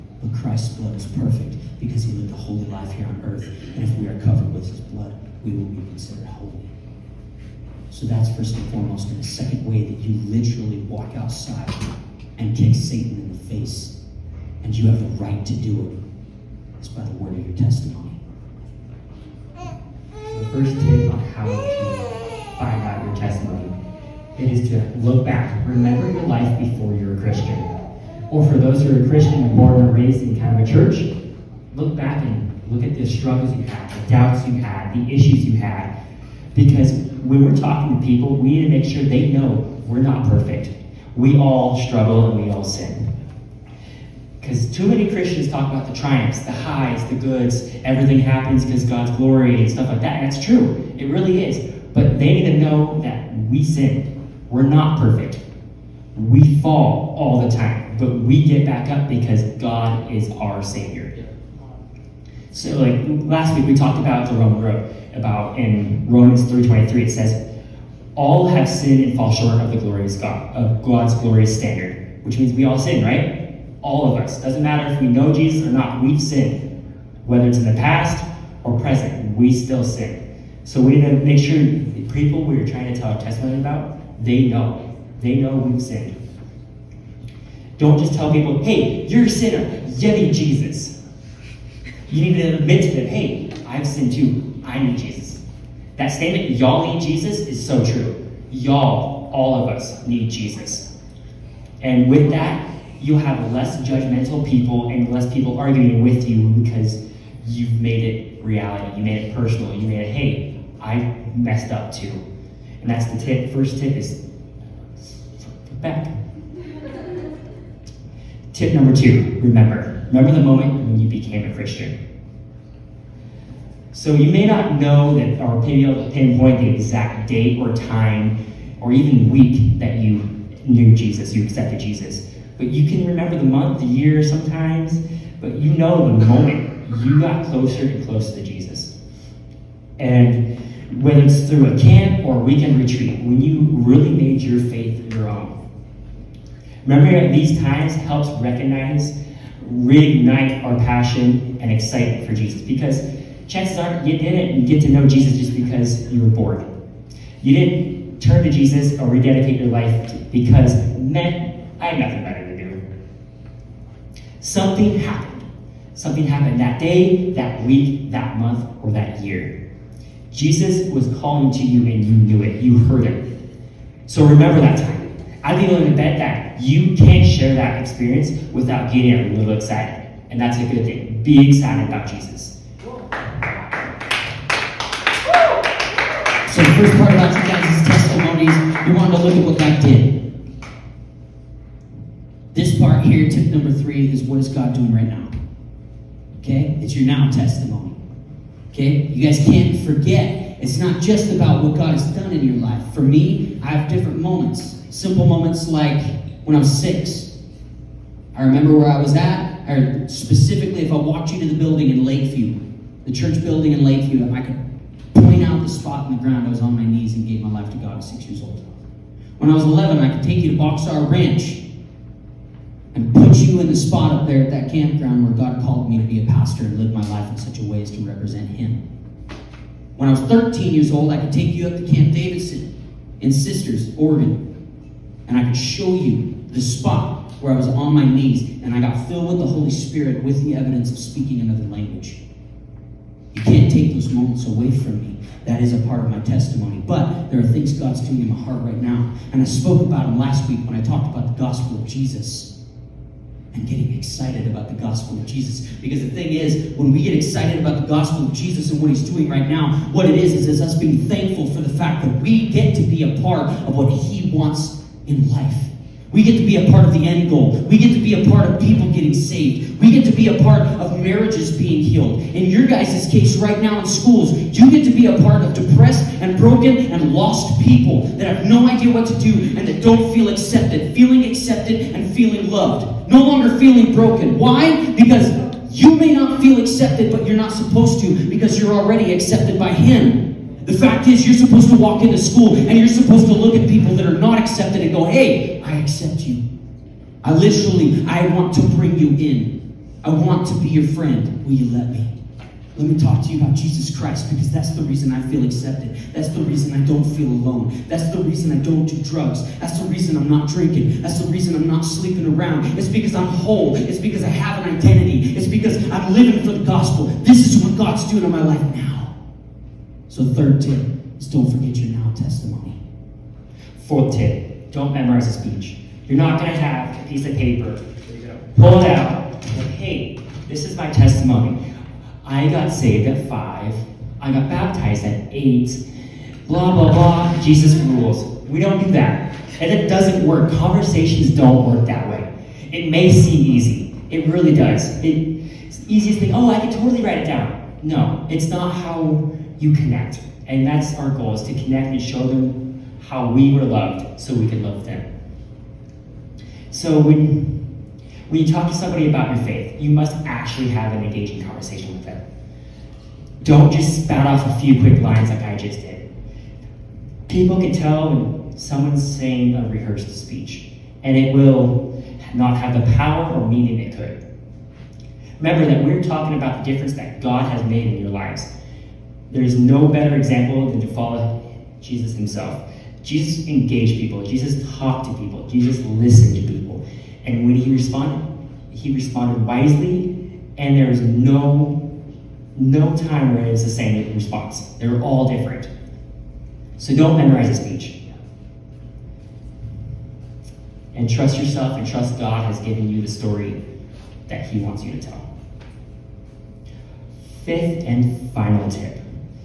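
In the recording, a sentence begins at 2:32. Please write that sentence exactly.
Because chances are you didn't get to know Jesus just because you were bored.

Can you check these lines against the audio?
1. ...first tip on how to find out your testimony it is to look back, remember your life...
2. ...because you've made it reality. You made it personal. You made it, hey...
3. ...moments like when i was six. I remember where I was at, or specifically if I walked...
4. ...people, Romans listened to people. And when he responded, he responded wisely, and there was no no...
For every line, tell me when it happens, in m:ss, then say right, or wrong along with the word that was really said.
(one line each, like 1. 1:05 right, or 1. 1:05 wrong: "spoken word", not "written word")
1. 0:20 right
2. 1:46 right
3. 3:25 right
4. 6:25 wrong: "Jesus", not "Romans".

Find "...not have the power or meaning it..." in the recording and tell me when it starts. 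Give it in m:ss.
6:12.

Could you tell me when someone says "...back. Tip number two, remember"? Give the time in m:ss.
1:55.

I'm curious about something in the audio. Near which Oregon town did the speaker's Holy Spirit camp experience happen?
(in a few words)
Sisters.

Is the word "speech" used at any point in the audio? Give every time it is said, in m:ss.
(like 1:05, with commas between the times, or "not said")
5:25, 6:10, 6:37.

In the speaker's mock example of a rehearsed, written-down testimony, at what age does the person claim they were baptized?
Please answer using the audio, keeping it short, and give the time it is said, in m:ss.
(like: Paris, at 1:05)
8, at 5:35.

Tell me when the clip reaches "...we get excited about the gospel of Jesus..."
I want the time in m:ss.
4:16.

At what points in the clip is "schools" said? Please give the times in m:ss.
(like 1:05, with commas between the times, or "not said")
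4:33, 4:52.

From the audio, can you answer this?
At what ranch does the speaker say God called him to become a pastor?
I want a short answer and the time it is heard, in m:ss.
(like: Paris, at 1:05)
Boxar Ranch, at 3:40.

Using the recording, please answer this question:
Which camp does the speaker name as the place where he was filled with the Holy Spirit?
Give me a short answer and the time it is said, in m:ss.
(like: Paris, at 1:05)
Camp Davidson, at 3:51.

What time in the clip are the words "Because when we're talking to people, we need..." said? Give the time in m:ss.
0:36.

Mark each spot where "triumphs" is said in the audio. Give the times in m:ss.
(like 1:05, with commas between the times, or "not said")
0:45.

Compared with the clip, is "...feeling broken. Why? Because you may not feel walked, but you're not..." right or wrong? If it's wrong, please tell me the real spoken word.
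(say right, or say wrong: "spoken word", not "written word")
wrong: "accepted", not "walked".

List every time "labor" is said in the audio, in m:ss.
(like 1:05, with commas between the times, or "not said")
not said.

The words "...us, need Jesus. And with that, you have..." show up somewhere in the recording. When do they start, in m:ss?
1:39.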